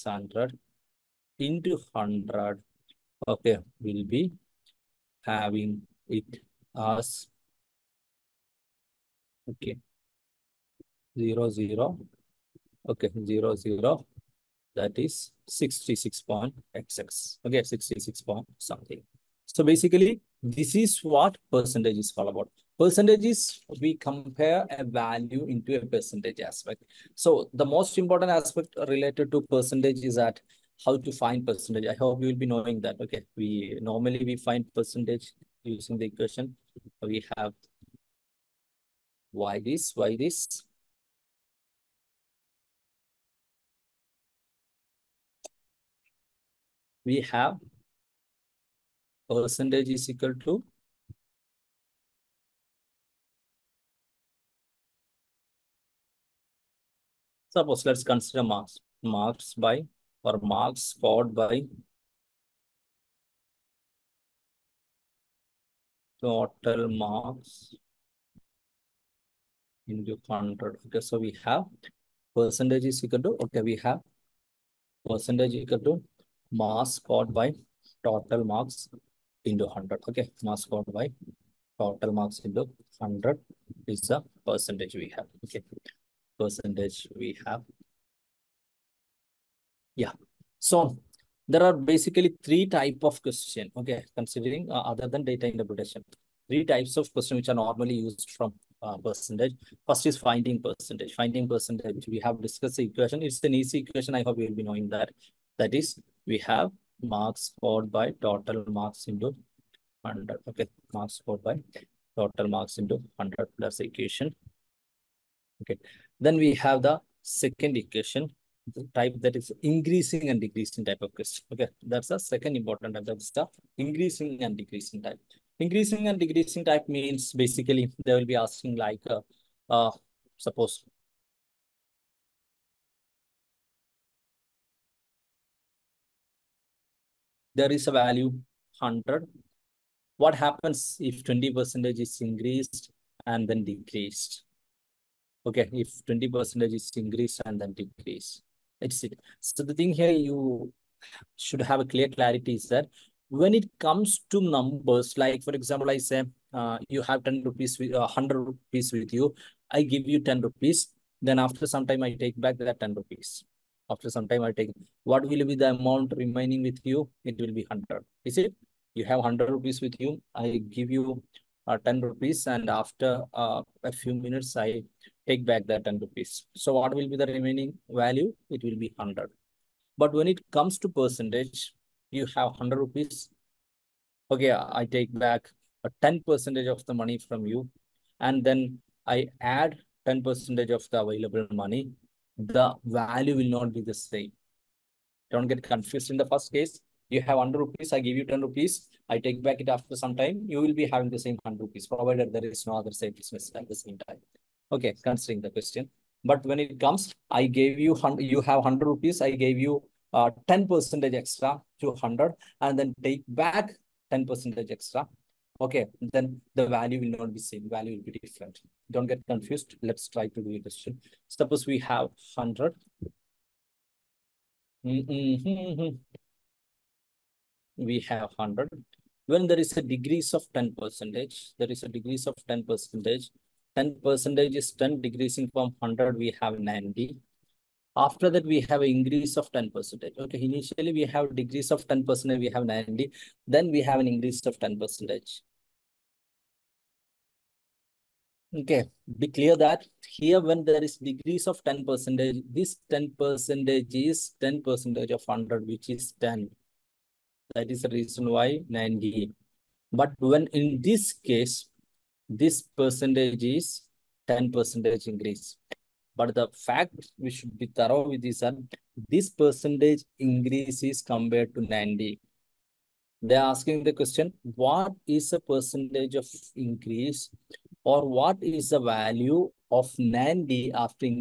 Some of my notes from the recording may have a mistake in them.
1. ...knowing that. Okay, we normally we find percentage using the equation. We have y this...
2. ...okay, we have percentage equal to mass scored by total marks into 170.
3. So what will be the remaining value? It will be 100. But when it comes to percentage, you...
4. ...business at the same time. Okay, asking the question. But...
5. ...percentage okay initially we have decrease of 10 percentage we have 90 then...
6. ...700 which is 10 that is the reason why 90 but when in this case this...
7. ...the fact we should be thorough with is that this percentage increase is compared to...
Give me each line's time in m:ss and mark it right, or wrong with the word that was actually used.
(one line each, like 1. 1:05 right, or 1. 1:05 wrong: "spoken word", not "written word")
1. 0:32 right
2. 1:13 wrong: "100", not "170"
3. 2:56 right
4. 3:23 wrong: "considering", not "asking"
5. 3:59 right
6. 4:15 wrong: "100", not "700"
7. 4:26 right.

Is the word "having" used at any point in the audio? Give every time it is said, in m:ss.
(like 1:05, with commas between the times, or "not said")
0:05, 3:20.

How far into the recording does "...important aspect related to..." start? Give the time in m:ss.
0:27.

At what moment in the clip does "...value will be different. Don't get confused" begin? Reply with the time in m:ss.
3:37.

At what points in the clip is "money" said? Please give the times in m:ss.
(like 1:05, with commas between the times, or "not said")
3:06, 3:11.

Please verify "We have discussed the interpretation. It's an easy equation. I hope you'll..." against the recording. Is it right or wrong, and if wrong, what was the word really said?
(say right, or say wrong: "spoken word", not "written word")
wrong: "equation", not "interpretation".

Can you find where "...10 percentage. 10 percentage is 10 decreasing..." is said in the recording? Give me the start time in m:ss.
3:52.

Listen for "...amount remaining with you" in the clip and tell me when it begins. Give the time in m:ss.
2:45.